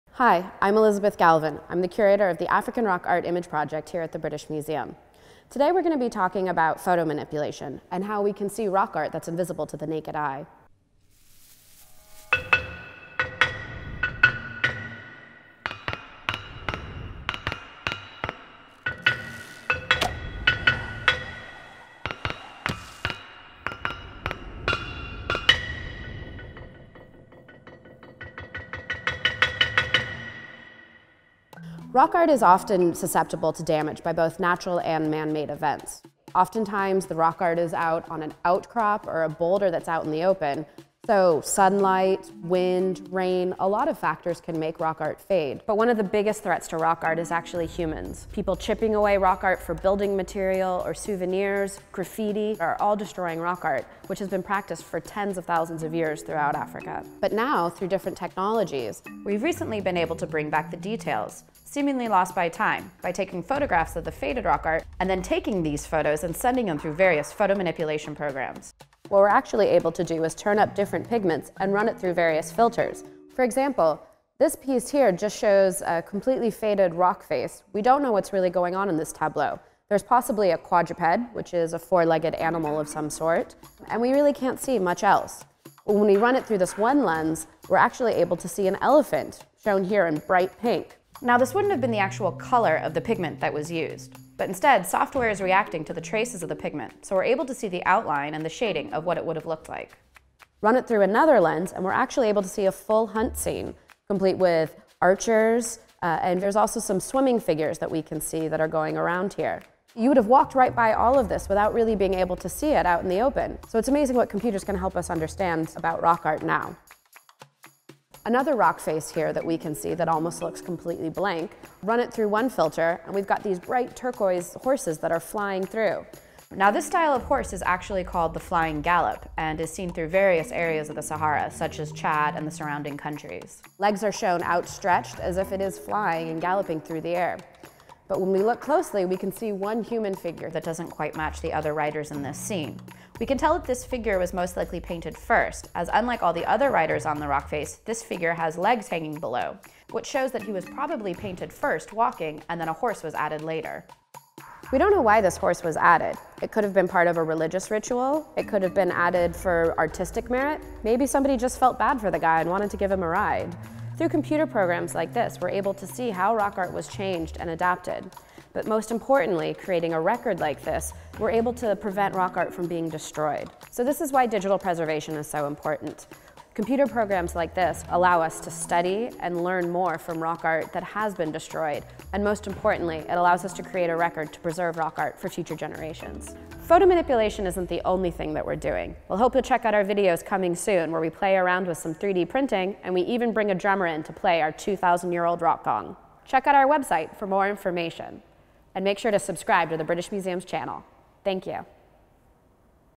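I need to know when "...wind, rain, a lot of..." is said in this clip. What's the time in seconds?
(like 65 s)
42 s.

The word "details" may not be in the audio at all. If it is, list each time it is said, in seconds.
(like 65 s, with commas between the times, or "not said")
60 s.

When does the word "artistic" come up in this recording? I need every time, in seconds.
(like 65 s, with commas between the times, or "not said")
159 s.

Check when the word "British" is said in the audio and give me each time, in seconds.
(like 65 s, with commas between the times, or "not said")
4 s, 199 s.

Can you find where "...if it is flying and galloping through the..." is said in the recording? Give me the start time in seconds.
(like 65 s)
135 s.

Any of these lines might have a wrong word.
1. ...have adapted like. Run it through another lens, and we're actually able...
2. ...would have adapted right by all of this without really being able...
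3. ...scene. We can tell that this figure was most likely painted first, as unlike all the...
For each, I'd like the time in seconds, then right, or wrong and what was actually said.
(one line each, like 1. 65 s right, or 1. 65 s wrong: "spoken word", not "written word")
1. 99 s wrong: "looked", not "adapted"
2. 110 s wrong: "walked", not "adapted"
3. 142 s right.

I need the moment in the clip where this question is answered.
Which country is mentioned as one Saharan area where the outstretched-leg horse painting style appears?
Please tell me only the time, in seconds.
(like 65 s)
131 s.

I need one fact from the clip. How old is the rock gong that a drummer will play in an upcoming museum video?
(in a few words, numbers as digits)
2,000 years.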